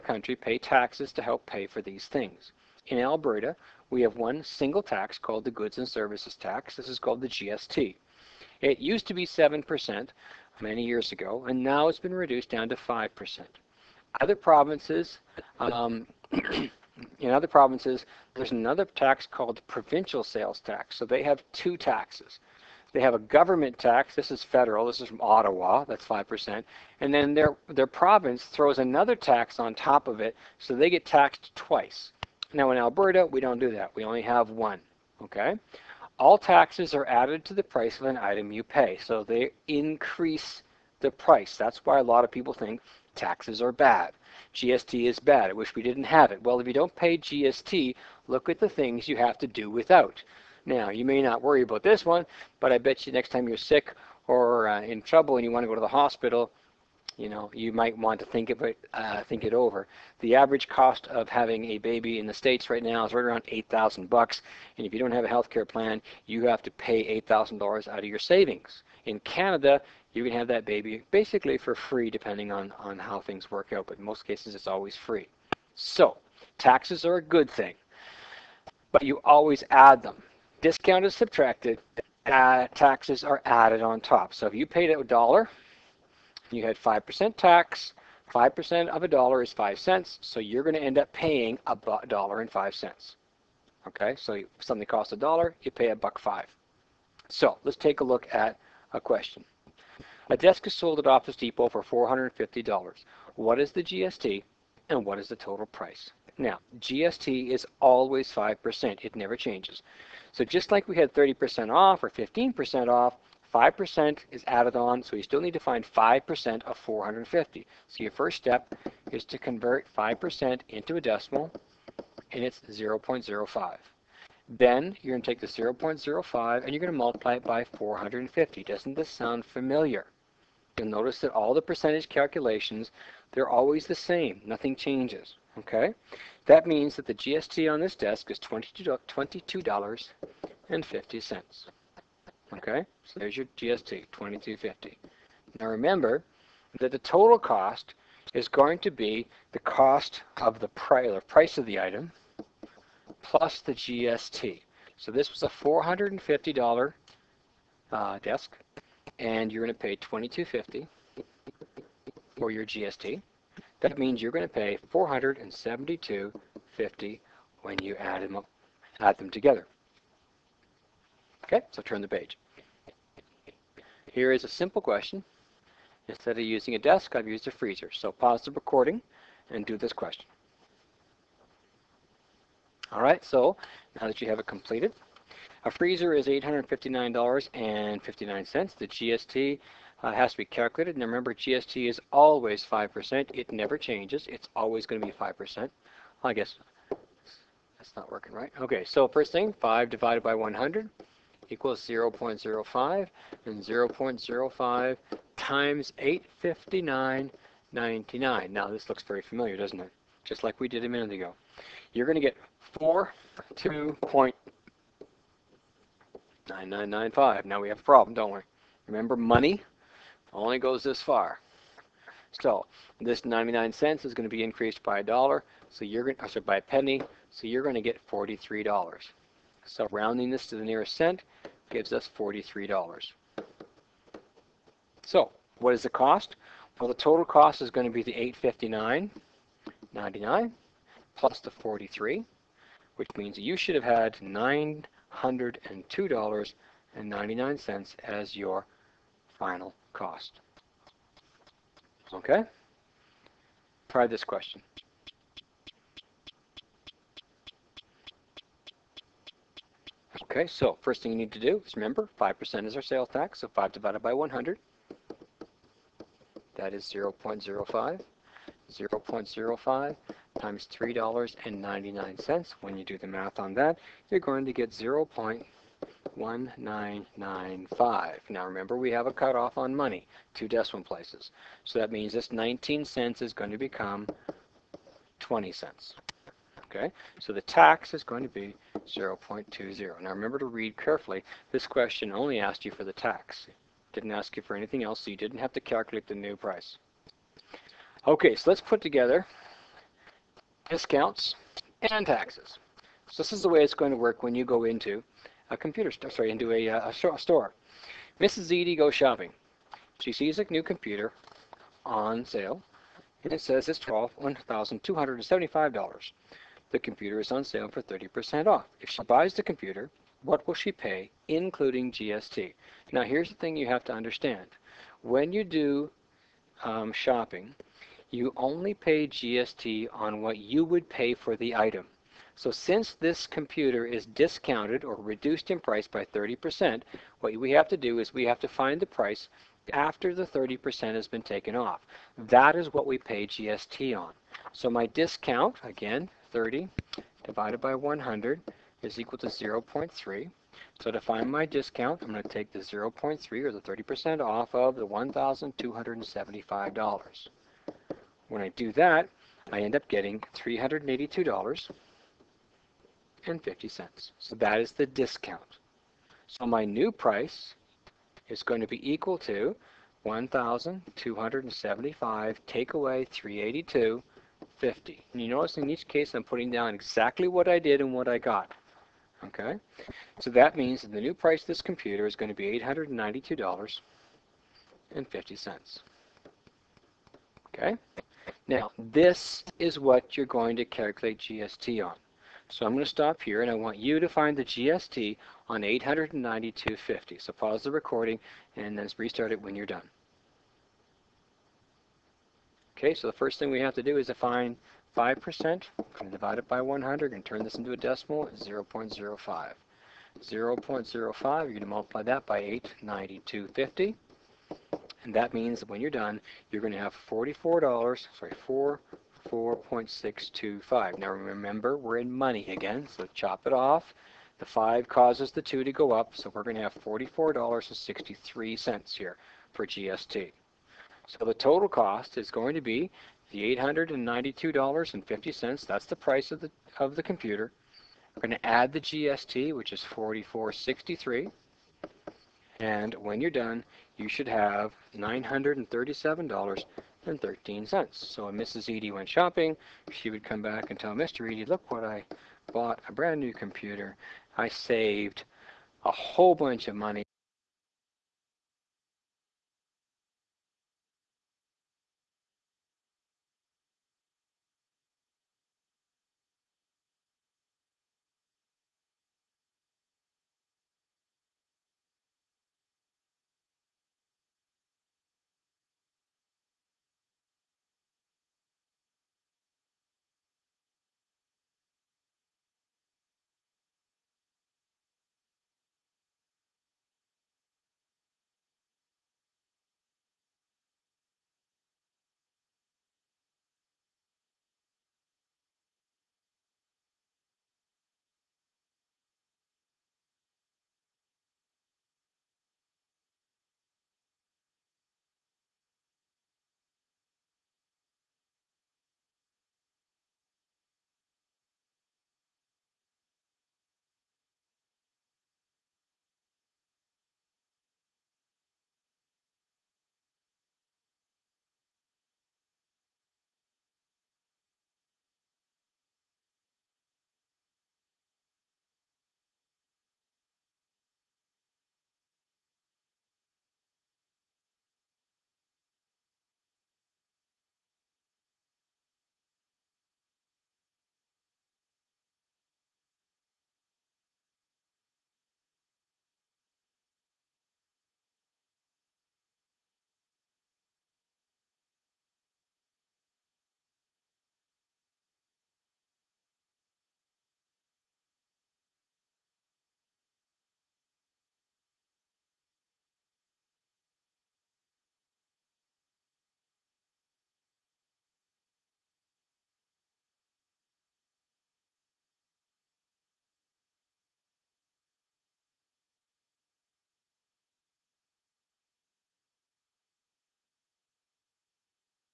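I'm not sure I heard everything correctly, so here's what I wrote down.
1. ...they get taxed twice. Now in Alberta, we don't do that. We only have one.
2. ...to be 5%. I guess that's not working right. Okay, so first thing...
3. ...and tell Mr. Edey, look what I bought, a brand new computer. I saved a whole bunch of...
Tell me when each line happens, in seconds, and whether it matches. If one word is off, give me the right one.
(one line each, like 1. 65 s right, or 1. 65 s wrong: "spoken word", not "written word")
1. 30 s right
2. 194 s right
3. 450 s right.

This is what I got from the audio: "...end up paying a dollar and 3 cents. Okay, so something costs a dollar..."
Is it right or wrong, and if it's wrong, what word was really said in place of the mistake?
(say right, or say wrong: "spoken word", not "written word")
wrong: "5", not "3".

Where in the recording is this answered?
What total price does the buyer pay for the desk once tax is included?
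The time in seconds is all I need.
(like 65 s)
164 s.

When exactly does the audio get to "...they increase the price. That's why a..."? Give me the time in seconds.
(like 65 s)
39 s.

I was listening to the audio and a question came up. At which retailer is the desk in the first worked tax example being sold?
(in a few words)
Office Depot.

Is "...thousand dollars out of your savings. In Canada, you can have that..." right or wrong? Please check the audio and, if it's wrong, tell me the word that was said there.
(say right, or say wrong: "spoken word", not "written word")
right.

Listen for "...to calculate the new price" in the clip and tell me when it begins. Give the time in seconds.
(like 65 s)
295 s.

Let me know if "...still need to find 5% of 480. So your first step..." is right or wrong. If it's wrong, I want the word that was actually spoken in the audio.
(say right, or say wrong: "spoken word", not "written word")
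wrong: "450", not "480".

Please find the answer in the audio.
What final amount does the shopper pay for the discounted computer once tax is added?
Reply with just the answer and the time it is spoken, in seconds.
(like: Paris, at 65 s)
$937.13, at 444 s.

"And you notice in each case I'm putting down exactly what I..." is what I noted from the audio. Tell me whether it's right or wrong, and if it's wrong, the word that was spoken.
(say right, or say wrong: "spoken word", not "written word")
right.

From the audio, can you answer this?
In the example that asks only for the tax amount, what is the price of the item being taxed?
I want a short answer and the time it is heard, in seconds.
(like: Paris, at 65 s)
$3.99, at 270 s.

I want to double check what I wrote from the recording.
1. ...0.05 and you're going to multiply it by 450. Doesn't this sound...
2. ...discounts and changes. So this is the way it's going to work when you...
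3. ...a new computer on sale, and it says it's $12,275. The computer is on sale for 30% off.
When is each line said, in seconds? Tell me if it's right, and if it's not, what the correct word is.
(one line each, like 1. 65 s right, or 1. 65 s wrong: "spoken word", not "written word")
1. 125 s right
2. 300 s wrong: "taxes", not "changes"
3. 310 s right.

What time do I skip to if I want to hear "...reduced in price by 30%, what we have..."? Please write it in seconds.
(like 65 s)
334 s.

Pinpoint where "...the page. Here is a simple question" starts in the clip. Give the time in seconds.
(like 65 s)
172 s.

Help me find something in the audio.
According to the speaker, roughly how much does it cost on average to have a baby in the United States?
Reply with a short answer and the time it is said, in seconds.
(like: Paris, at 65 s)
$8,000, at 63 s.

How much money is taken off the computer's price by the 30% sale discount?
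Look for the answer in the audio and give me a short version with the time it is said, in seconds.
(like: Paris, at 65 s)
$382.50, at 360 s.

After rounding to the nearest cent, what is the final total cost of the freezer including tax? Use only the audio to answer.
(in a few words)
$902.99.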